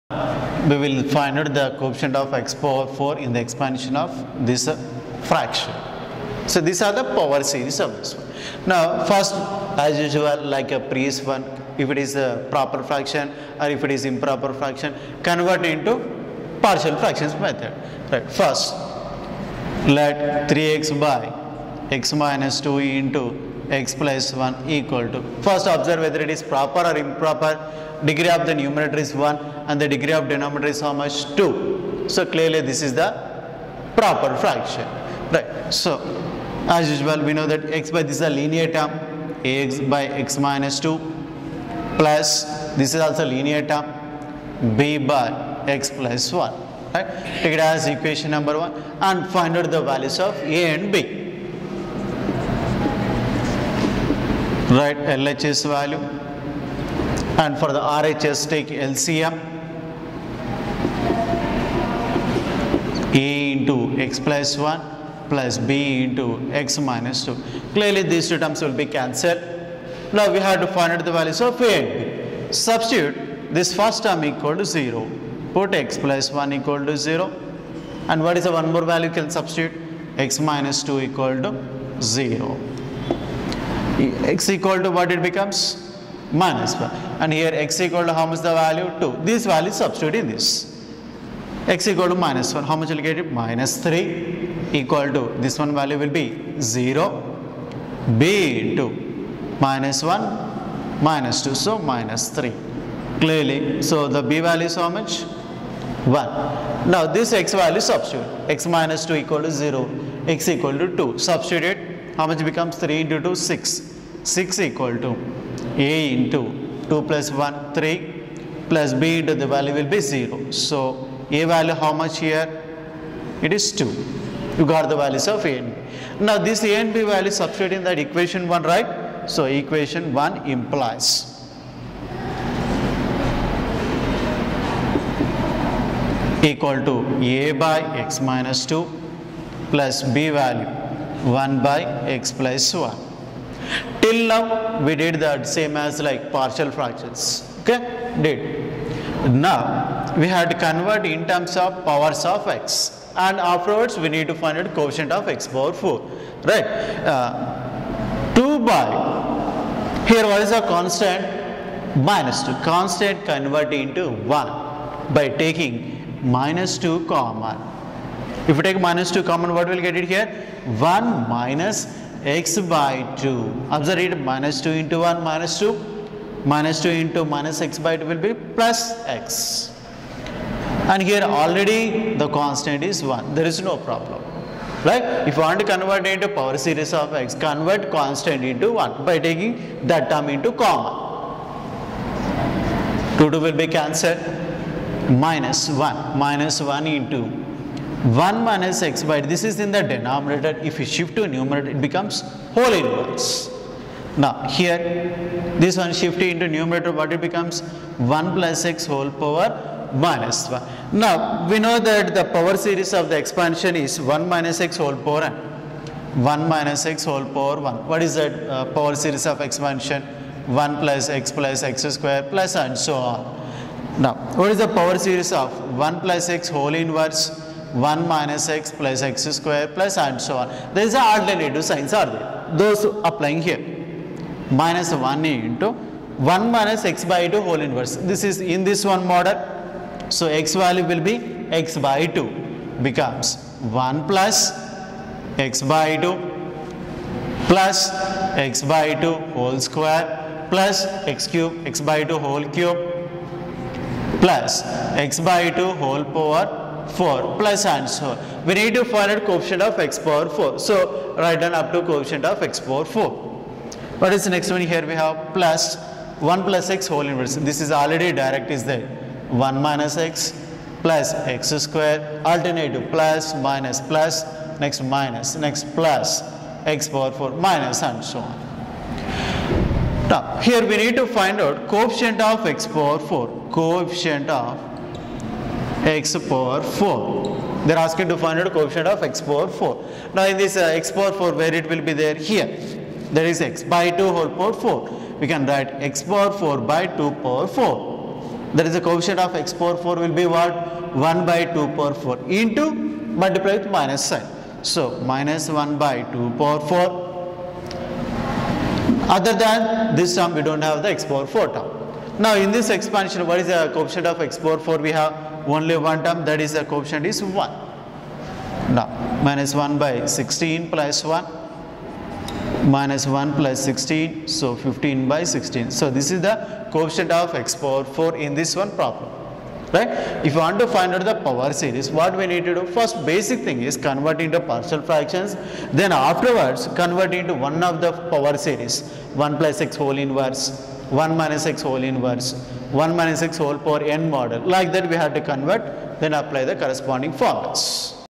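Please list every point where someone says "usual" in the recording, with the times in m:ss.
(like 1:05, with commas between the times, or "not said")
0:09, 0:36.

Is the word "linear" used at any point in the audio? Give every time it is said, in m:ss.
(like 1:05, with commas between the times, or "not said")
0:38, 0:43.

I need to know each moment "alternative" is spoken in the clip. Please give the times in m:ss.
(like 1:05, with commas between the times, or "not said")
3:51, 4:32.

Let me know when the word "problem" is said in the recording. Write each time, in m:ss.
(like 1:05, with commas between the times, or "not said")
3:03, 5:28.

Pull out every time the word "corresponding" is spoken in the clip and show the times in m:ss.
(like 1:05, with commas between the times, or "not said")
5:46.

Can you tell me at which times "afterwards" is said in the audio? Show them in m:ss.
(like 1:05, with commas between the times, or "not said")
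2:33, 5:35.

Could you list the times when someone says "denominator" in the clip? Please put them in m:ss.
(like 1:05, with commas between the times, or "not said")
0:30, 3:19.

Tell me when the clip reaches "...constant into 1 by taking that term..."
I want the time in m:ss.
3:07.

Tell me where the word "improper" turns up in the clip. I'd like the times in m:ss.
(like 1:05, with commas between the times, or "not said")
0:14, 0:26.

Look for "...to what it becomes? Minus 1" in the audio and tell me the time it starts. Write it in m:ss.
1:24.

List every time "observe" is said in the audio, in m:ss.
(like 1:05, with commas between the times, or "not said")
0:25, 2:53.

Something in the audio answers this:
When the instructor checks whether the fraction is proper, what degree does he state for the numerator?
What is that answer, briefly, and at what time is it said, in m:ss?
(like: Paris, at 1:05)
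1, at 0:28.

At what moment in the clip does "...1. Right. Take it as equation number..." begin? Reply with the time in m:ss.
0:46.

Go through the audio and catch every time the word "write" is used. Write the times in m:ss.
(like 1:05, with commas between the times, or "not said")
0:54, 4:21, 4:55.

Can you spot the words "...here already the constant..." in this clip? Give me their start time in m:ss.
3:01.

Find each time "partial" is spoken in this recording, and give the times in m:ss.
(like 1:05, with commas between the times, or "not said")
0:16, 2:26, 5:34.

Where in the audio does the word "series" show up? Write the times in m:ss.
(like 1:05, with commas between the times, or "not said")
0:07, 3:06, 3:32, 3:38, 3:45, 5:31, 5:38.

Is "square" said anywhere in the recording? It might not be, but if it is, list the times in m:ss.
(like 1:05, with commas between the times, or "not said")
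3:41, 3:49, 4:09, 4:31.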